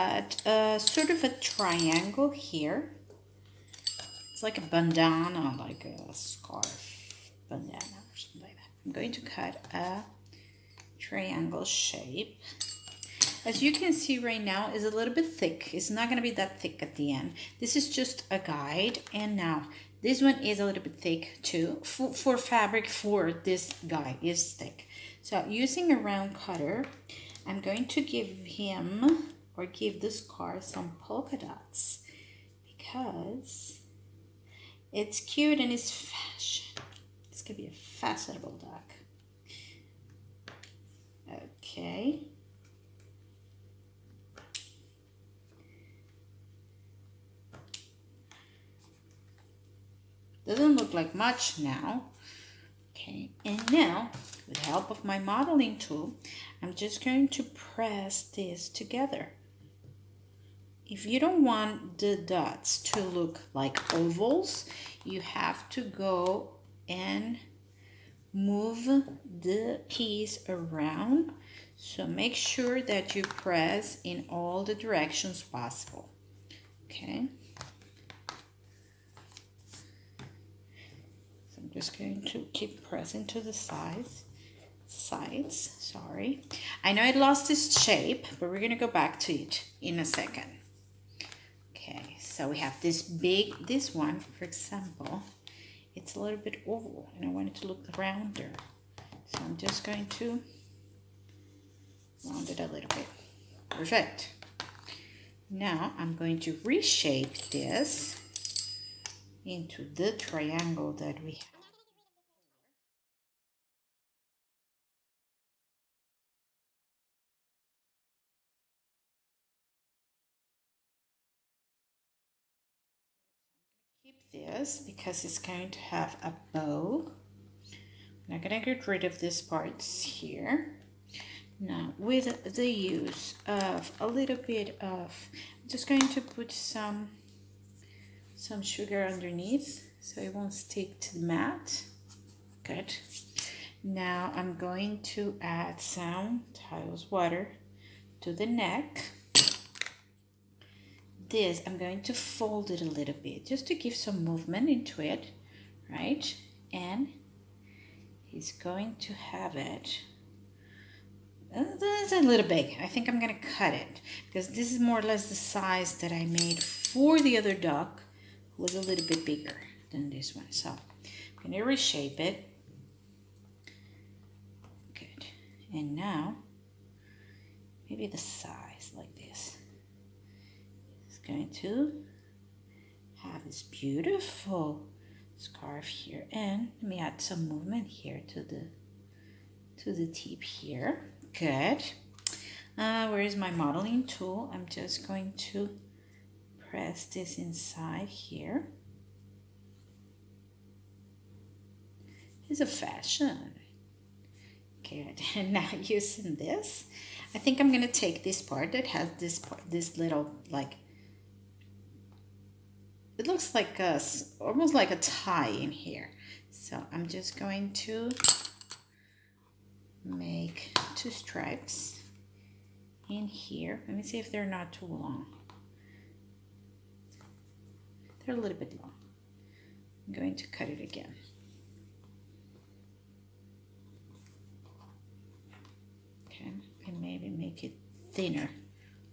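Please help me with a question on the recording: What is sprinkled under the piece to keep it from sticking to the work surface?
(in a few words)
sugar.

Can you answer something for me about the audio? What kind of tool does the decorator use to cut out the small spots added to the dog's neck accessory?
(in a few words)
round cutter.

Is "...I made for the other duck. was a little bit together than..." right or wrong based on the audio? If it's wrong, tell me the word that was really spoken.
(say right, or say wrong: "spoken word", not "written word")
wrong: "bigger", not "together".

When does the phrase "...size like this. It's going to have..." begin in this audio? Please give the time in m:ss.
2:58.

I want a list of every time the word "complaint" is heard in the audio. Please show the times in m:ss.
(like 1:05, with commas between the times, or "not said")
not said.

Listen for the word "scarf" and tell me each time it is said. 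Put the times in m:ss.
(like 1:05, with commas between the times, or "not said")
0:06, 3:05.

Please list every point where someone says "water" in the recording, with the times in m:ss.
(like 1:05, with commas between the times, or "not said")
2:27.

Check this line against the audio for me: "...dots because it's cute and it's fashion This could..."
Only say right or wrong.
right.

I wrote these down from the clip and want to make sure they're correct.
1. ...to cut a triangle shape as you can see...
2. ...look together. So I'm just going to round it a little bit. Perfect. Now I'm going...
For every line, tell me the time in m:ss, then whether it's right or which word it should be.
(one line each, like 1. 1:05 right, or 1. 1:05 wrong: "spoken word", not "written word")
1. 0:09 right
2. 1:37 wrong: "rounder", not "together".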